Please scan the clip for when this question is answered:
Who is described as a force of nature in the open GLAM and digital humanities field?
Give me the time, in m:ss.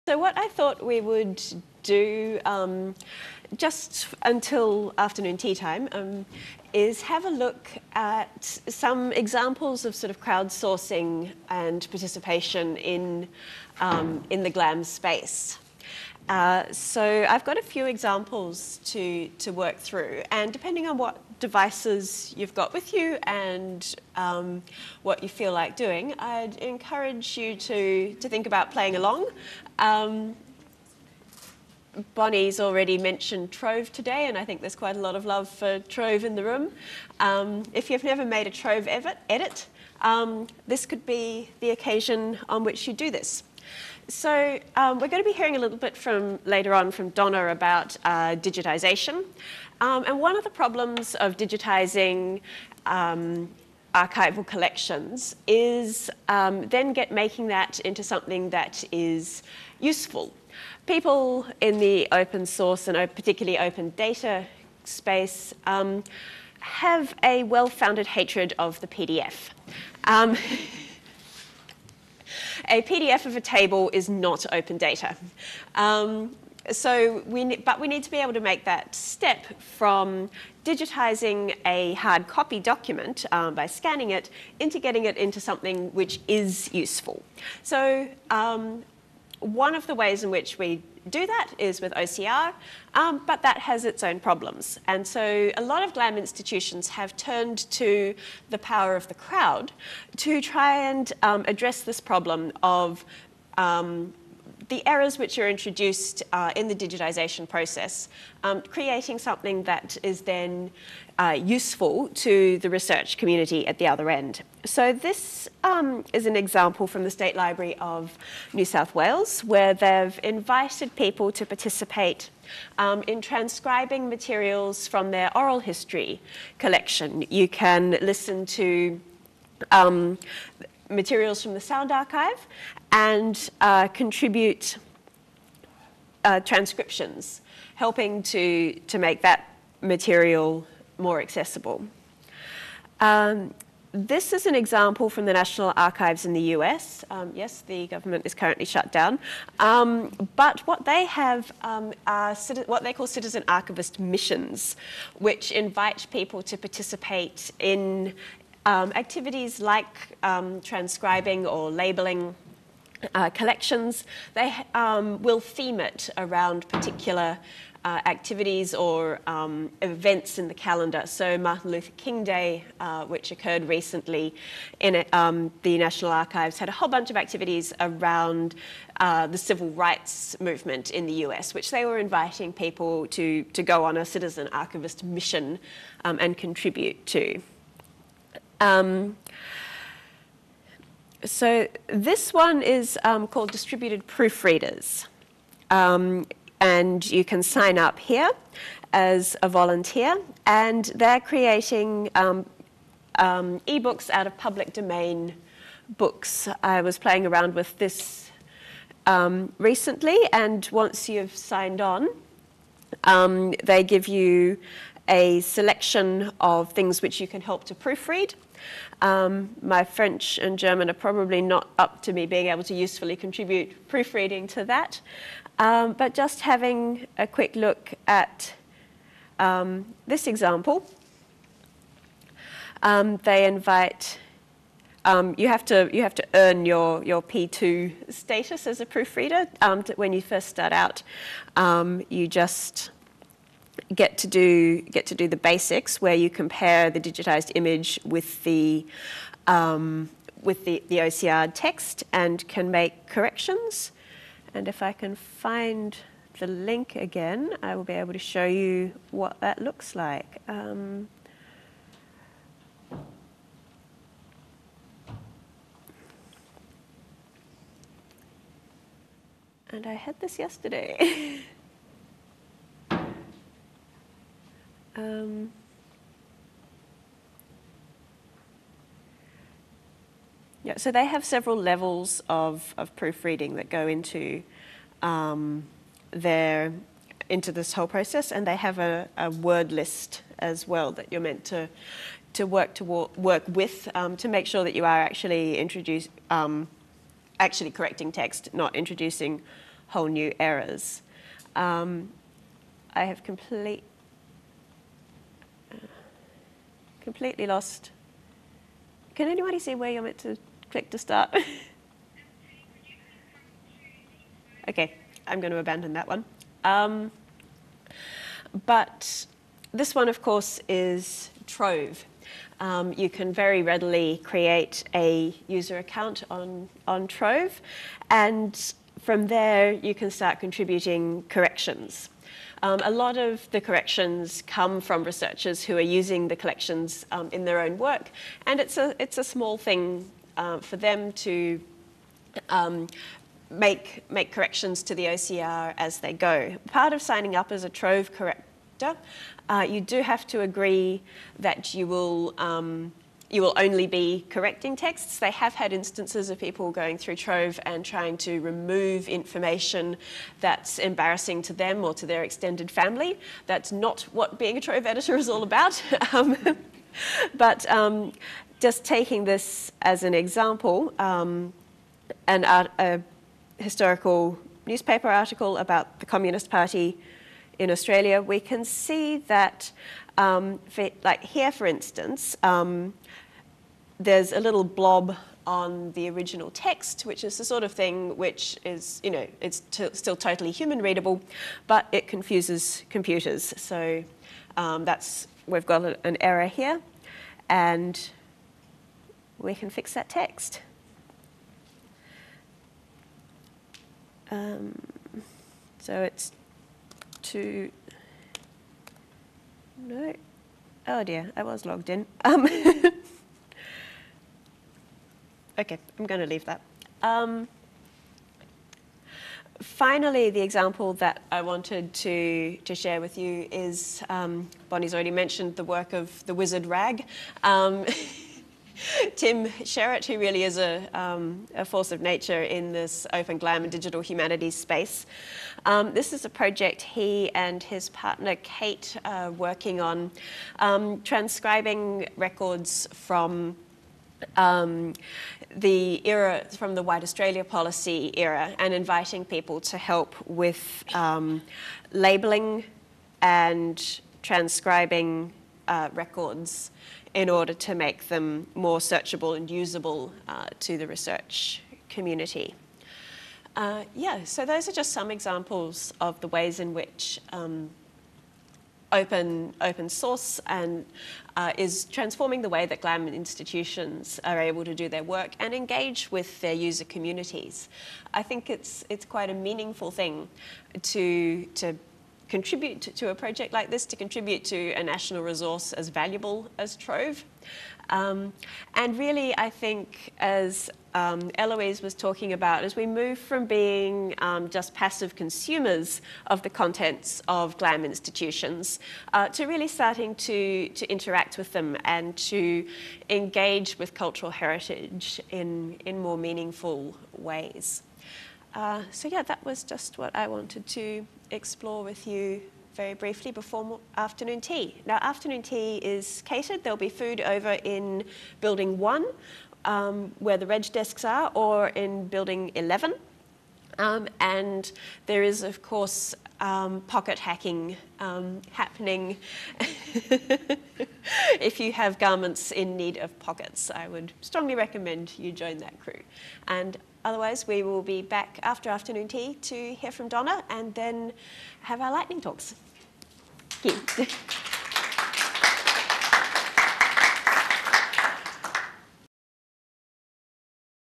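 7:09.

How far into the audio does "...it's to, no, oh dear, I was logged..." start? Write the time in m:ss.
6:46.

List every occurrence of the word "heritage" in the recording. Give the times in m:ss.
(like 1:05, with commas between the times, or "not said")
8:24.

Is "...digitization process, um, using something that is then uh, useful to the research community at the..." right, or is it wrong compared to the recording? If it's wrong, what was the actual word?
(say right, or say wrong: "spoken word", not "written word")
wrong: "creating", not "using".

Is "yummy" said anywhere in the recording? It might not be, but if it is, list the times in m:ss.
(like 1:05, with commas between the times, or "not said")
not said.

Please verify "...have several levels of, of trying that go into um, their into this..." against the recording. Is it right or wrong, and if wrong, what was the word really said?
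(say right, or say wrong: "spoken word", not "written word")
wrong: "proofreading", not "trying".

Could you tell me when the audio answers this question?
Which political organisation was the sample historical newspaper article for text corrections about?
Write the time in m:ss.
6:16.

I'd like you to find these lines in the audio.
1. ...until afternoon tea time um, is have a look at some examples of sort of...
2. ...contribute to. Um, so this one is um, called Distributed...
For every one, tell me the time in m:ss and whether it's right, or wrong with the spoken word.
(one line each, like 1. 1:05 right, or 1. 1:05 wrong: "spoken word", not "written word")
1. 0:04 right
2. 3:06 right.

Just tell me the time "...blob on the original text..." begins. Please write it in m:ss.
6:24.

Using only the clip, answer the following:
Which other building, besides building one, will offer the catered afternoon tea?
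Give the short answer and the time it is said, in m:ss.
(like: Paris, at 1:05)
Building 11, at 8:42.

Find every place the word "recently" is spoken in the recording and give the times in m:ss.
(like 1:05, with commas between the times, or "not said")
2:53, 3:29.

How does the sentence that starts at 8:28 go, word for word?
Uh, so yeah, that was just what I wanted to explore with you very briefly before afternoon tea.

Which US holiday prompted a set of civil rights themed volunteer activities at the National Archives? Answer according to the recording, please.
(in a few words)
Martin Luther King Day.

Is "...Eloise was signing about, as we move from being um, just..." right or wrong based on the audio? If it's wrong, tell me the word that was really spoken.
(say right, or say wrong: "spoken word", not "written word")
wrong: "talking", not "signing".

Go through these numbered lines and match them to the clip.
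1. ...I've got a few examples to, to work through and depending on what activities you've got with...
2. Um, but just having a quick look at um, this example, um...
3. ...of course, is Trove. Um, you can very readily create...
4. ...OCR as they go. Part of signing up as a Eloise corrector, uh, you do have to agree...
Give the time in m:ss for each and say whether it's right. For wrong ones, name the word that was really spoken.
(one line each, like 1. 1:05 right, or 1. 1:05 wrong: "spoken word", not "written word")
1. 0:17 wrong: "devices", not "activities"
2. 3:45 right
3. 5:20 right
4. 5:45 wrong: "Trove", not "Eloise".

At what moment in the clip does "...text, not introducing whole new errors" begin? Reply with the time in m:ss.
4:58.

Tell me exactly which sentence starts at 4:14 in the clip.
And if I can find the link again, I will be able to show you what that looks like.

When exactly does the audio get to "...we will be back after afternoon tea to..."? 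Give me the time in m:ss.
8:57.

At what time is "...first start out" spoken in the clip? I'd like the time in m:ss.
4:00.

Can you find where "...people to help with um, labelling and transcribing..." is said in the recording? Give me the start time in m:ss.
7:29.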